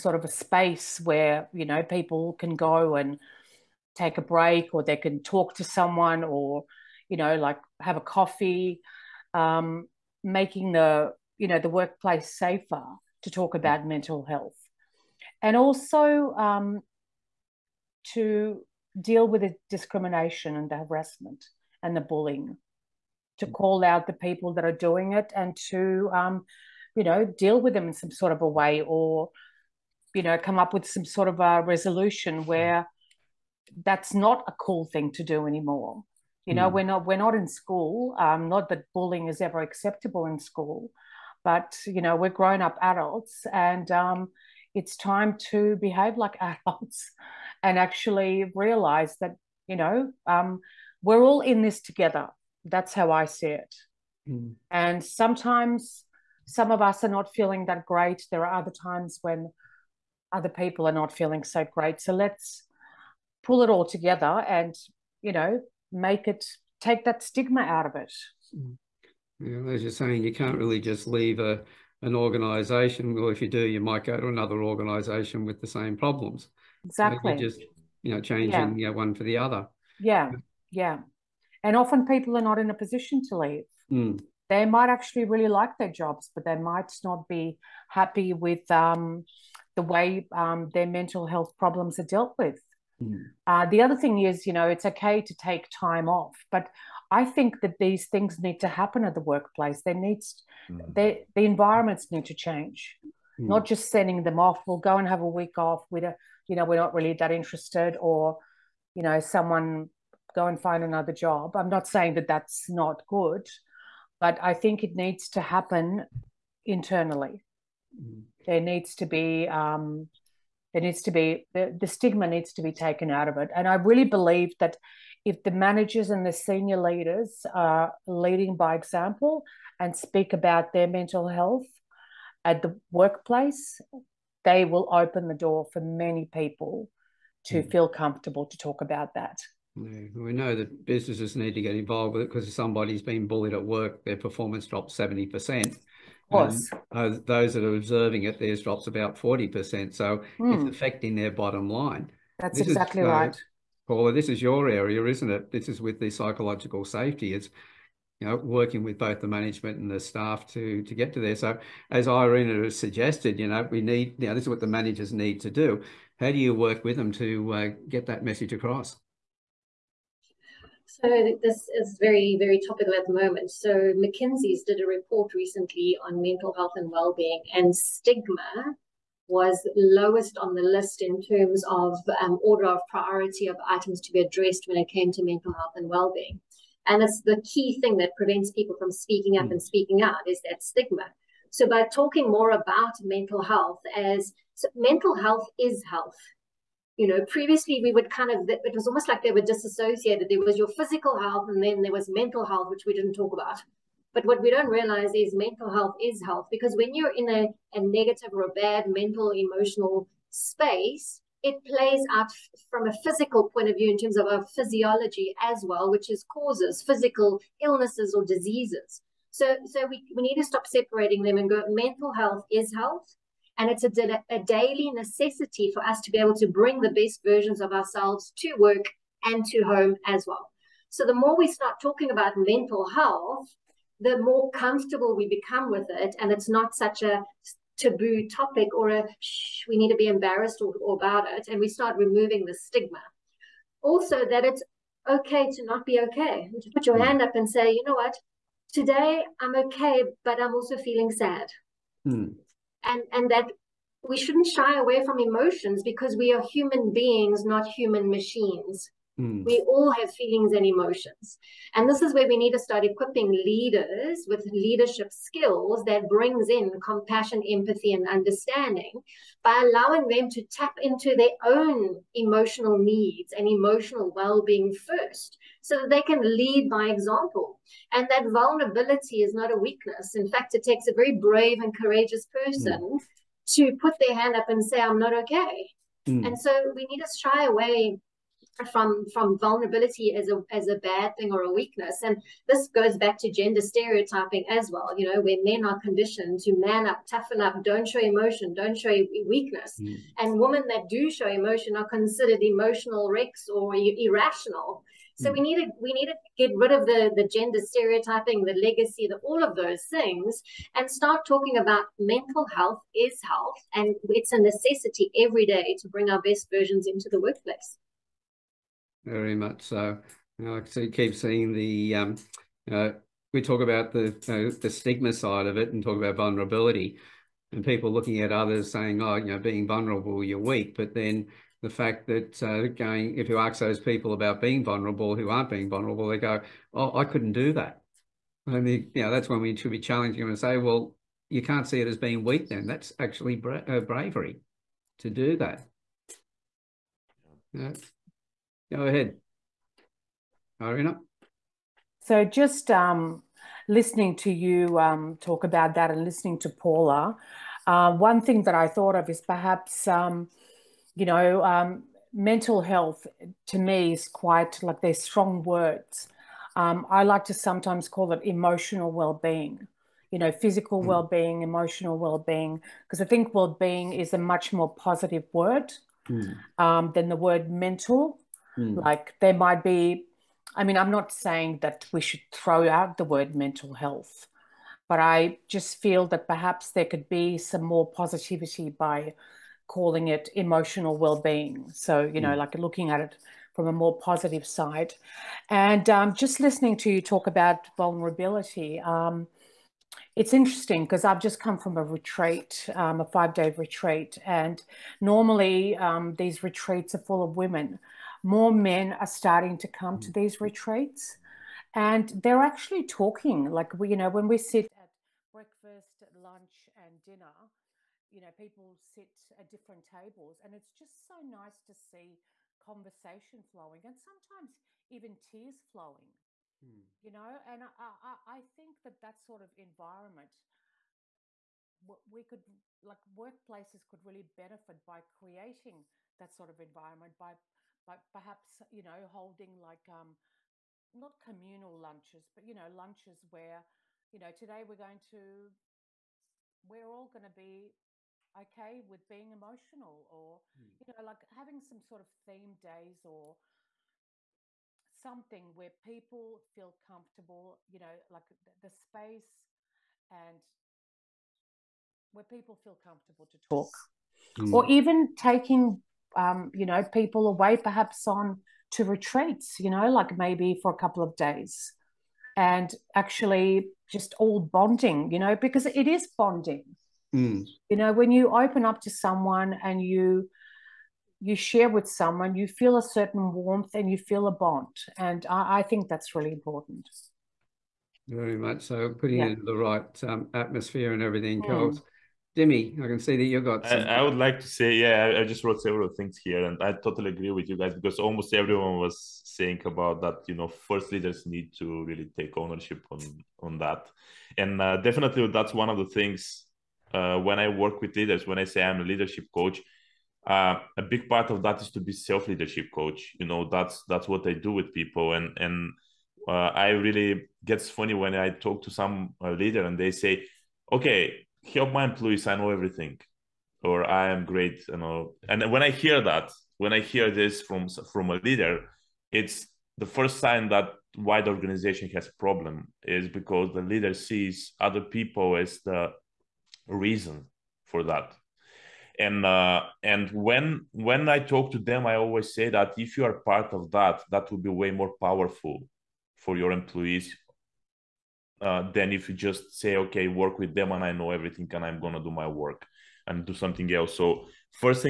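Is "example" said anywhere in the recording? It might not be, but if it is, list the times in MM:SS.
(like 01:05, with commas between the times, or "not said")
02:08, 04:36.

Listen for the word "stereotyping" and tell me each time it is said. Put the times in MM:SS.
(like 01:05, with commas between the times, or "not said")
04:53, 05:07.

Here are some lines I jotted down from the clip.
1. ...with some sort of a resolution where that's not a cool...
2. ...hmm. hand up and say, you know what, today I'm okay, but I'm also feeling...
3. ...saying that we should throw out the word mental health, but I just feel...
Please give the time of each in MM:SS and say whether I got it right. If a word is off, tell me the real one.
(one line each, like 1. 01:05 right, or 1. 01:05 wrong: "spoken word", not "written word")
1. 00:30 right
2. 04:06 right
3. 06:21 right.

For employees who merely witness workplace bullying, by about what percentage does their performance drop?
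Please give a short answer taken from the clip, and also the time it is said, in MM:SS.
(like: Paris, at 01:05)
40%, at 02:29.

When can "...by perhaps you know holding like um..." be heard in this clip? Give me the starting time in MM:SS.
07:17.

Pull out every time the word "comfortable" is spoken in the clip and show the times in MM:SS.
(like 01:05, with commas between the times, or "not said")
02:17, 03:54, 07:36, 07:42.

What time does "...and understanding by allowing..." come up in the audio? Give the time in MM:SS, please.
04:27.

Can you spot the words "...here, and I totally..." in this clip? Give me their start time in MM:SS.
08:16.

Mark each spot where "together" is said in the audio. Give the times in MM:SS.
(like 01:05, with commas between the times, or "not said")
00:51, 01:03.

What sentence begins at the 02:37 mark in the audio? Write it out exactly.
It's you know working with both the management and the staff to to get to there.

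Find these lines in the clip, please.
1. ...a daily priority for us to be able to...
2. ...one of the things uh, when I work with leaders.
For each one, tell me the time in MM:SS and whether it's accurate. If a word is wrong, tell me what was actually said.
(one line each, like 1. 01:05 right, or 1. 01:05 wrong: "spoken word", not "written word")
1. 03:44 wrong: "necessity", not "priority"
2. 08:25 right.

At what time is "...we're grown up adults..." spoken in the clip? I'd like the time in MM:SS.
00:42.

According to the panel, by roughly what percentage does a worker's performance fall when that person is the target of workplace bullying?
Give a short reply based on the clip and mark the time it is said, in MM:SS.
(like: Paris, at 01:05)
70%, at 02:24.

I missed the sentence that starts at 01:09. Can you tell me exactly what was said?
as you're saying you can't really just leave a an organization.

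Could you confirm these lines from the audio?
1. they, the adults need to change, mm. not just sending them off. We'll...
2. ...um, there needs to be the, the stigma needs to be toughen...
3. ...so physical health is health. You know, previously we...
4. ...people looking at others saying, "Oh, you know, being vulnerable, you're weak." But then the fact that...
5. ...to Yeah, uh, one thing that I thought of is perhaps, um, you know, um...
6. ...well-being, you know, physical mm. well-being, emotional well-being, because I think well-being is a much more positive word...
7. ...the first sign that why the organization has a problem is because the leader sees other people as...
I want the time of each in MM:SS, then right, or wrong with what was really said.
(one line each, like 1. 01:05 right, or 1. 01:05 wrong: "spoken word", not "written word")
1. 01:40 wrong: "environments", not "adults"
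2. 01:59 wrong: "taken", not "toughen"
3. 03:14 wrong: "mental", not "physical"
4. 05:27 right
5. 05:56 wrong: "Paula", not "Yeah"
6. 06:08 right
7. 08:49 right.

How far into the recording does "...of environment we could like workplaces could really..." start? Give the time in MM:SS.
07:09.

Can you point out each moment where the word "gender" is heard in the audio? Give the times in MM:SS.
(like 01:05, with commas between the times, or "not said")
04:53, 05:07.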